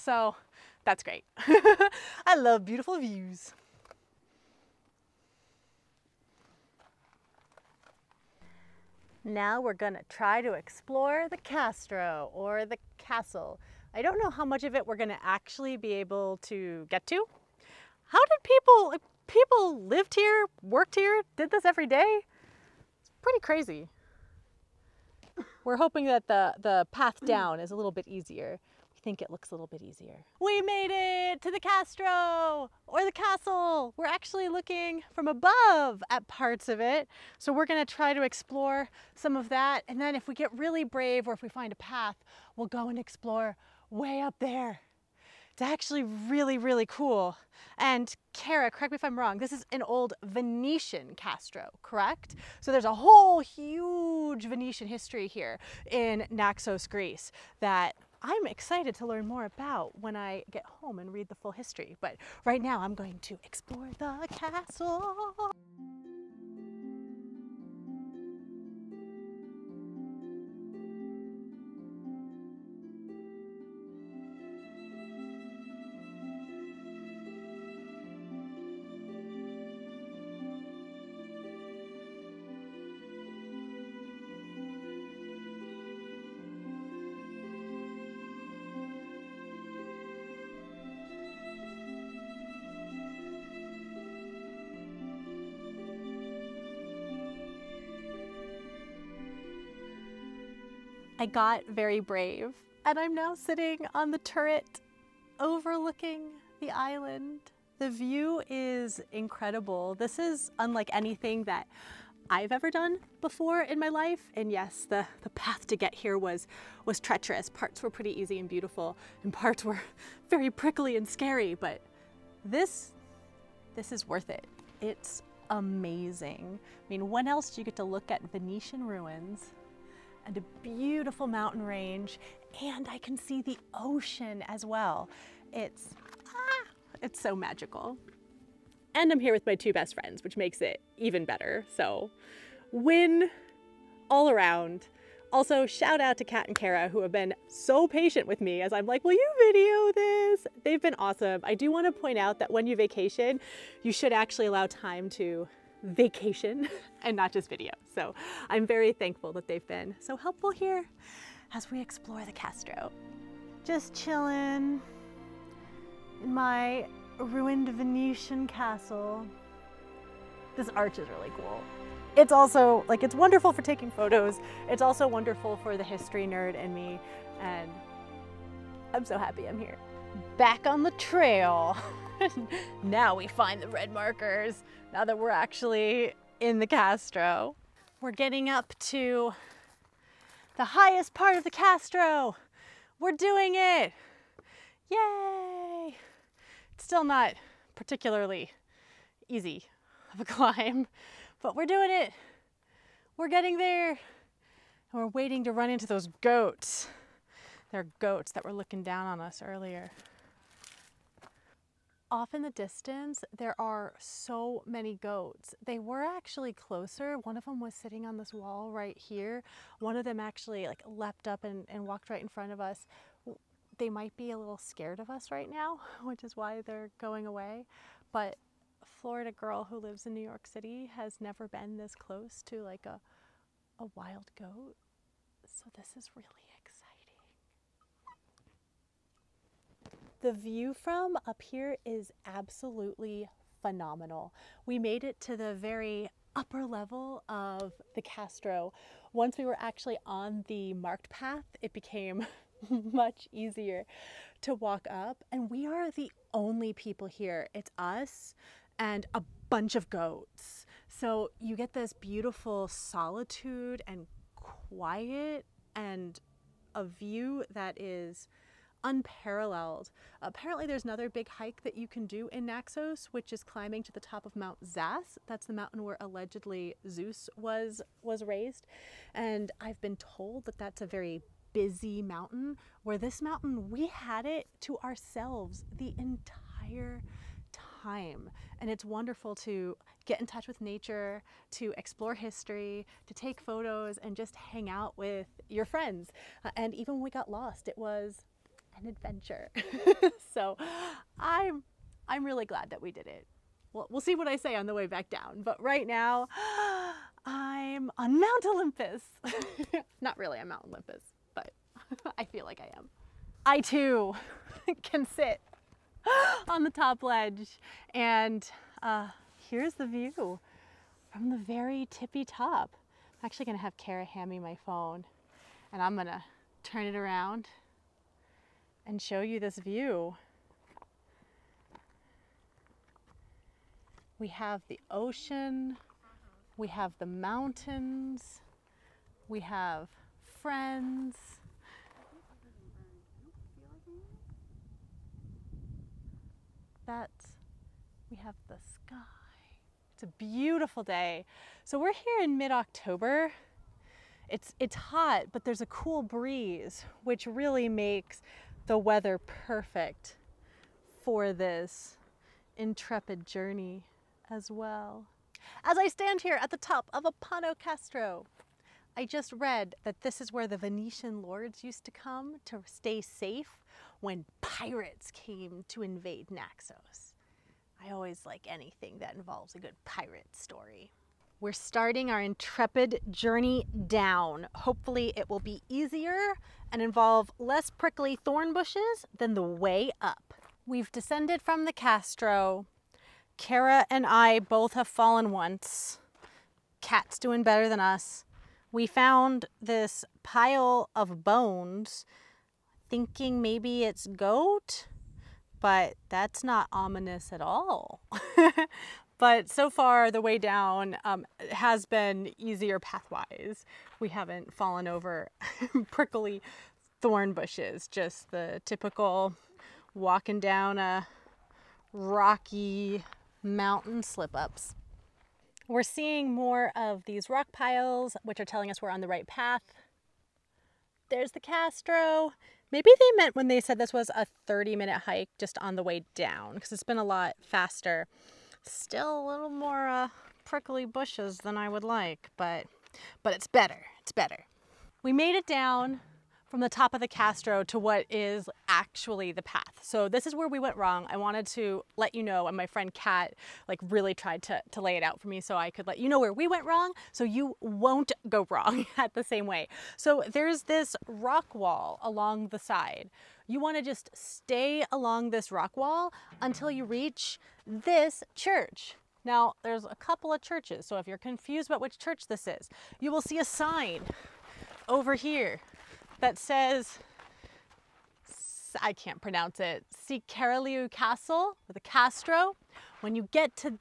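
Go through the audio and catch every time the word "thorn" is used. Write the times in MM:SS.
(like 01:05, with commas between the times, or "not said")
06:28, 06:57.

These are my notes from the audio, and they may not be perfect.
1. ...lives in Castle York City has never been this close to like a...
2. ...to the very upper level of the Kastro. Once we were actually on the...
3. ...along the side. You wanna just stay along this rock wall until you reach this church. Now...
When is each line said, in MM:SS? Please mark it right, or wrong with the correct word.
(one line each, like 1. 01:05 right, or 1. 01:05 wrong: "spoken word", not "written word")
1. 03:49 wrong: "New", not "Castle"
2. 04:05 right
3. 07:42 right.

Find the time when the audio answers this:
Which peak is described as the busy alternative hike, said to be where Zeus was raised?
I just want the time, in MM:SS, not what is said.
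04:34.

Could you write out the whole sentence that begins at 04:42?
Where this mountain, we had it to ourselves the entire time.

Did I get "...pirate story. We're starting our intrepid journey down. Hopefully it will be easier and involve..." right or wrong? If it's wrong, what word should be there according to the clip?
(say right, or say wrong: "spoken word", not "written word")
right.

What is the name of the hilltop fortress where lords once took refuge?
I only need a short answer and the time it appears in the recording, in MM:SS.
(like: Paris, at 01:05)
Apano Kastro, at 06:07.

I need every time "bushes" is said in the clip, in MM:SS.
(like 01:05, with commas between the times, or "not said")
06:28, 06:57, 07:20.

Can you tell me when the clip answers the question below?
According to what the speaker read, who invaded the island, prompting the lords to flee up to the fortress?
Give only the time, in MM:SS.
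06:14.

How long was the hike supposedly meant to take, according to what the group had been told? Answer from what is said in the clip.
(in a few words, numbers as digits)
30 minutes.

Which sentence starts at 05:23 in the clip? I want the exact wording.
I'm actually gonna have Kara hand me my phone and I'm gonna turn it around and show you this view.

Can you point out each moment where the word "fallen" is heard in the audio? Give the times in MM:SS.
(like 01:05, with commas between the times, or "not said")
06:34, 06:54.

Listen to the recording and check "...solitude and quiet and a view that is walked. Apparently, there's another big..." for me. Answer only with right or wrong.
wrong.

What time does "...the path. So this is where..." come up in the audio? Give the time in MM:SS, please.
07:29.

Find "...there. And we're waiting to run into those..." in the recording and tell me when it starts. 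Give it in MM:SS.
03:23.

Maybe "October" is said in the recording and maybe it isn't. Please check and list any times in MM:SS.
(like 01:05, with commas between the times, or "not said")
05:52.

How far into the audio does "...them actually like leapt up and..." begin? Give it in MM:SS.
03:40.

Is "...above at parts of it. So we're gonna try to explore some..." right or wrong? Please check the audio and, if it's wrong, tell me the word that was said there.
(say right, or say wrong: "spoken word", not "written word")
right.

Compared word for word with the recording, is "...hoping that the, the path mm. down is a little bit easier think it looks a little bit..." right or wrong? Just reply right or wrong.
right.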